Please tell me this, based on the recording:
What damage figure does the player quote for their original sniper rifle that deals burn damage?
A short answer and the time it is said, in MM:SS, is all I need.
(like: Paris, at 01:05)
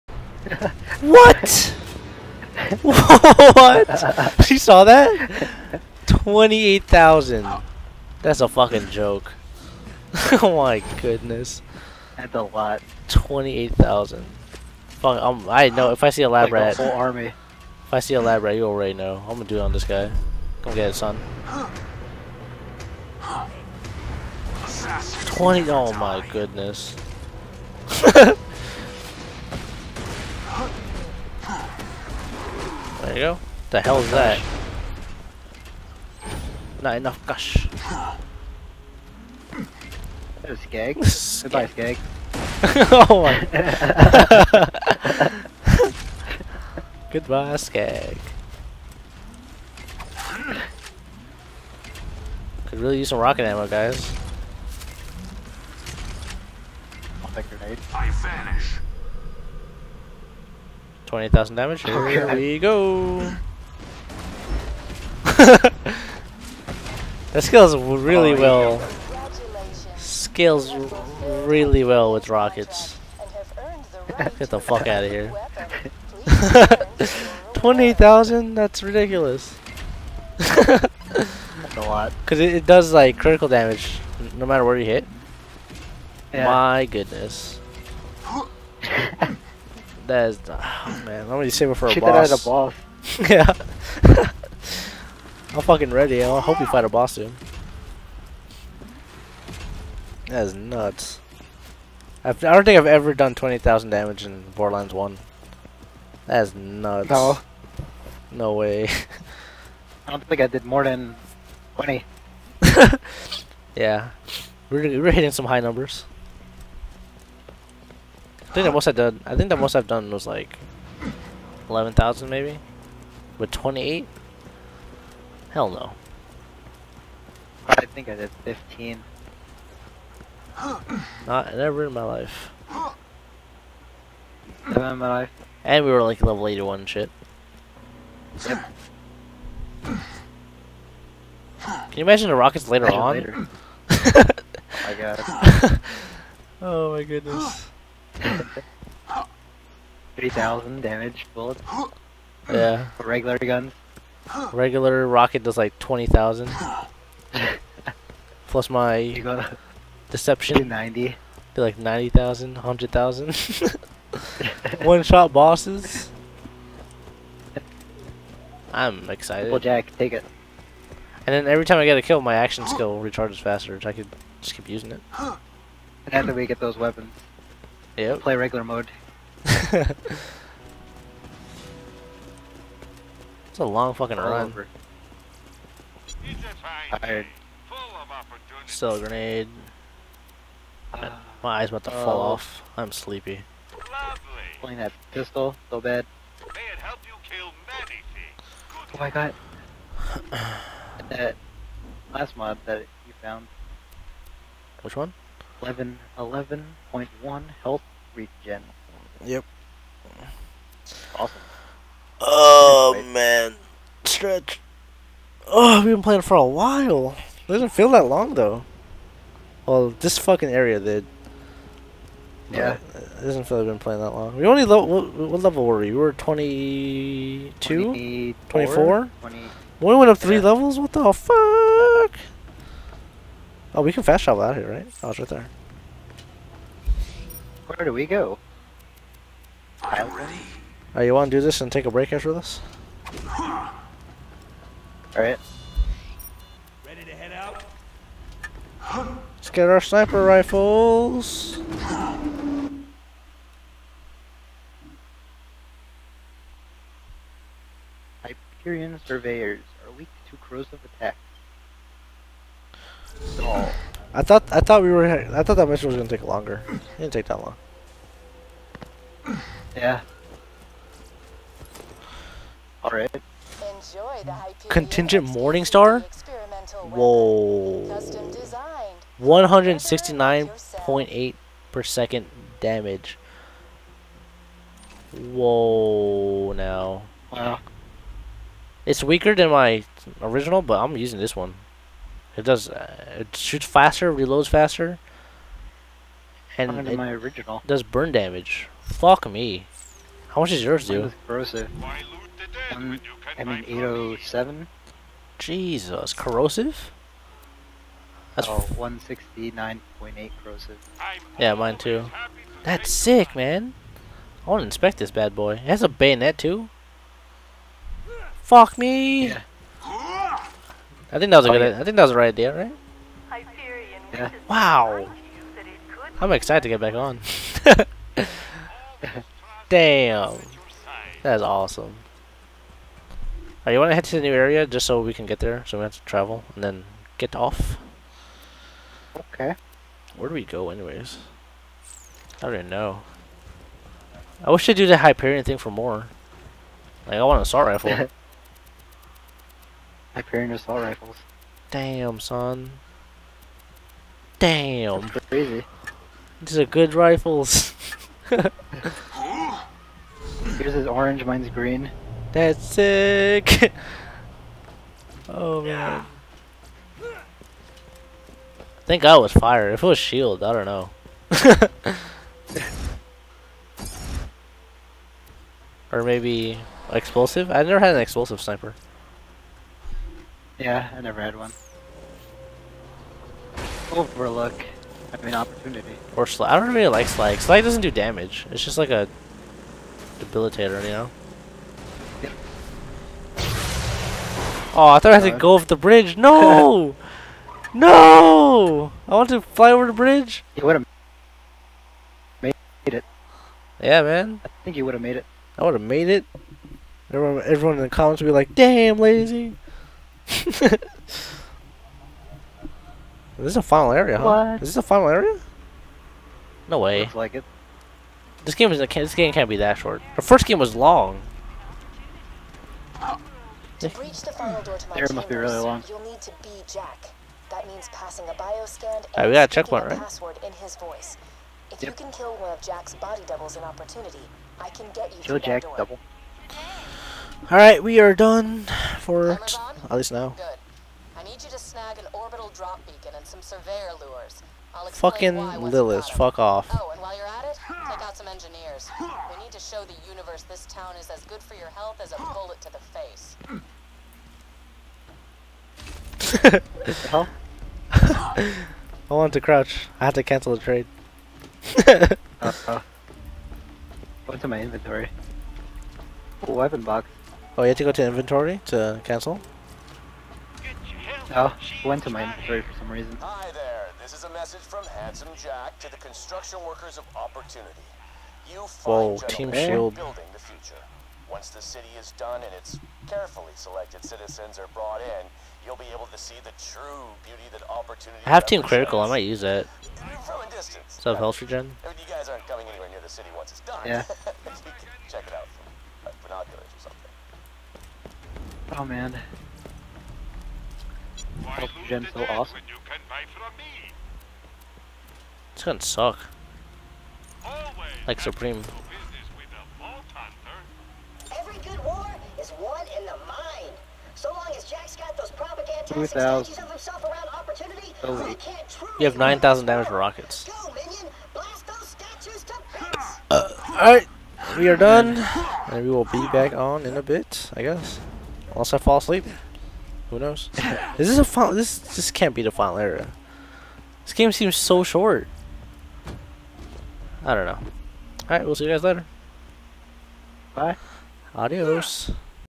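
807, at 05:03.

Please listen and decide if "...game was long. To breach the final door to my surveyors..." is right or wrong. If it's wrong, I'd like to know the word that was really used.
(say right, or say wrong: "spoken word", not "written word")
wrong: "chambers", not "surveyors".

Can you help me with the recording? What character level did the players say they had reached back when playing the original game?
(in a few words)
81.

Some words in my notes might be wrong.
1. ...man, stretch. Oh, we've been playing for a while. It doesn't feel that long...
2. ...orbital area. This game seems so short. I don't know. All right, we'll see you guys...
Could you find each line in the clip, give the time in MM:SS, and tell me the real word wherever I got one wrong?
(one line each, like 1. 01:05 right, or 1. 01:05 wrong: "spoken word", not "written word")
1. 03:33 right
2. 08:52 wrong: "final", not "orbital".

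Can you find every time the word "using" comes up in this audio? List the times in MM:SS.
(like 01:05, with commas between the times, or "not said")
02:54, 04:50.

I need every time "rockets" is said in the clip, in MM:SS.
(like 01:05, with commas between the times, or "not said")
00:53, 01:12, 02:22, 02:35, 08:39.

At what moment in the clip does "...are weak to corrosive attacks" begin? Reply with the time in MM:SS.
04:19.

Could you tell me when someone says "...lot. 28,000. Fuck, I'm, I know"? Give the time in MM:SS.
00:12.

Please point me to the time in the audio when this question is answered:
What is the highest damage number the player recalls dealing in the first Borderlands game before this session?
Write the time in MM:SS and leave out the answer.
02:01.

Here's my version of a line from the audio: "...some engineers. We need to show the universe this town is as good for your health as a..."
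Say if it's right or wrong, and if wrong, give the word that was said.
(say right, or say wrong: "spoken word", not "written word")
right.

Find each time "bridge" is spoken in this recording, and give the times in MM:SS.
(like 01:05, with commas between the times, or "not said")
06:35, 06:39.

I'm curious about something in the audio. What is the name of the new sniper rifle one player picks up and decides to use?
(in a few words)
Contingent Morningstar.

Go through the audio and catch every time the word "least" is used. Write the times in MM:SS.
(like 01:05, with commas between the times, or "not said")
07:19.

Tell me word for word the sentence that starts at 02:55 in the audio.
And after we get those weapons, Yep.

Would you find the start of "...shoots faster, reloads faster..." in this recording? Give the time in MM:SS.
04:53.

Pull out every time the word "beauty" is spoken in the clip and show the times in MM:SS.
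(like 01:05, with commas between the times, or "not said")
08:07.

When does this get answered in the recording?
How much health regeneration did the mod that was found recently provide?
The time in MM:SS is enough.
03:26.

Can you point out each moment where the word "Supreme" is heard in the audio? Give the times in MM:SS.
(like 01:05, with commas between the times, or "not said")
08:28.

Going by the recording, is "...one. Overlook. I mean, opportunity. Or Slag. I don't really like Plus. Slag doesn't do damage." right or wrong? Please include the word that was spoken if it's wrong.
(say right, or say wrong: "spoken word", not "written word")
wrong: "Slag", not "Plus".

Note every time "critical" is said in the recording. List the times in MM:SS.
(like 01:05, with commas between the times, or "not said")
01:23, 08:08.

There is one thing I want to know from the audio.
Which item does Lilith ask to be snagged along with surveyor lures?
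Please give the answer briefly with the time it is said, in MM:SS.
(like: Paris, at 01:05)
orbital drop beacon, at 07:22.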